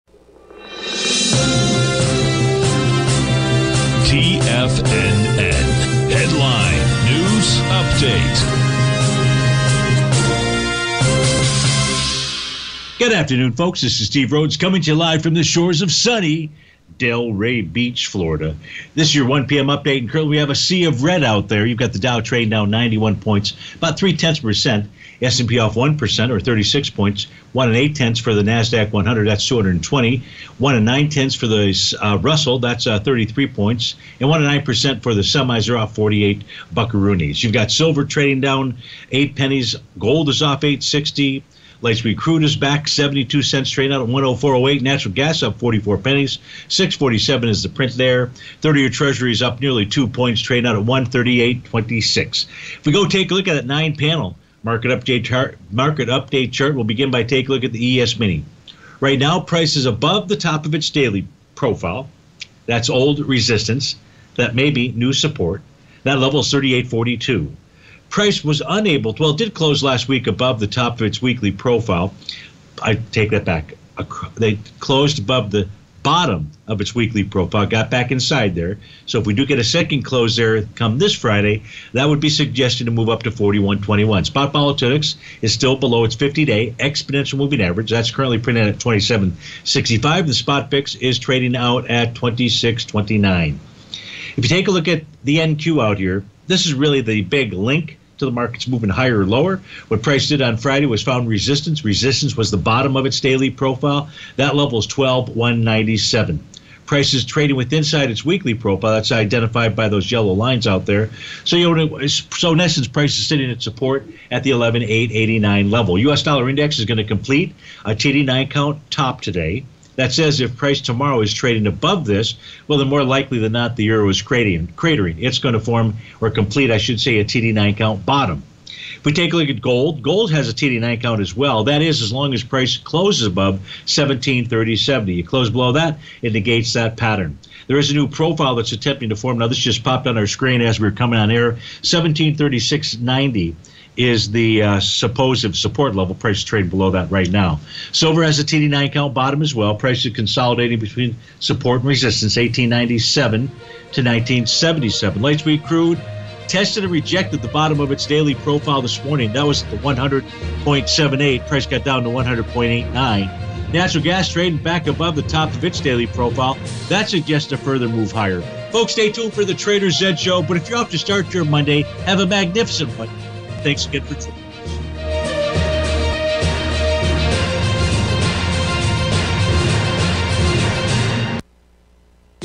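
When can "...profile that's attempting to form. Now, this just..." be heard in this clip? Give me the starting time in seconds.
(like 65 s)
138 s.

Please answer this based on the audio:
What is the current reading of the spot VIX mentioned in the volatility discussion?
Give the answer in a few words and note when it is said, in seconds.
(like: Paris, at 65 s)
26.29, at 92 s.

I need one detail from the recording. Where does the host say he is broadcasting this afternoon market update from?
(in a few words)
Delray Beach, Florida.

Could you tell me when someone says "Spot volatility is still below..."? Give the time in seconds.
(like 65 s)
84 s.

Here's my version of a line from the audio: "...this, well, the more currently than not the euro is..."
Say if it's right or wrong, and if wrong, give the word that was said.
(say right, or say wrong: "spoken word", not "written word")
wrong: "likely", not "currently".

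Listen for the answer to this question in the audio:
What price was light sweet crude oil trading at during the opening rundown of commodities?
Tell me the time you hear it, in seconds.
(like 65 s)
44 s.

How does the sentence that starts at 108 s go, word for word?
That's identified by those yellow lines out there.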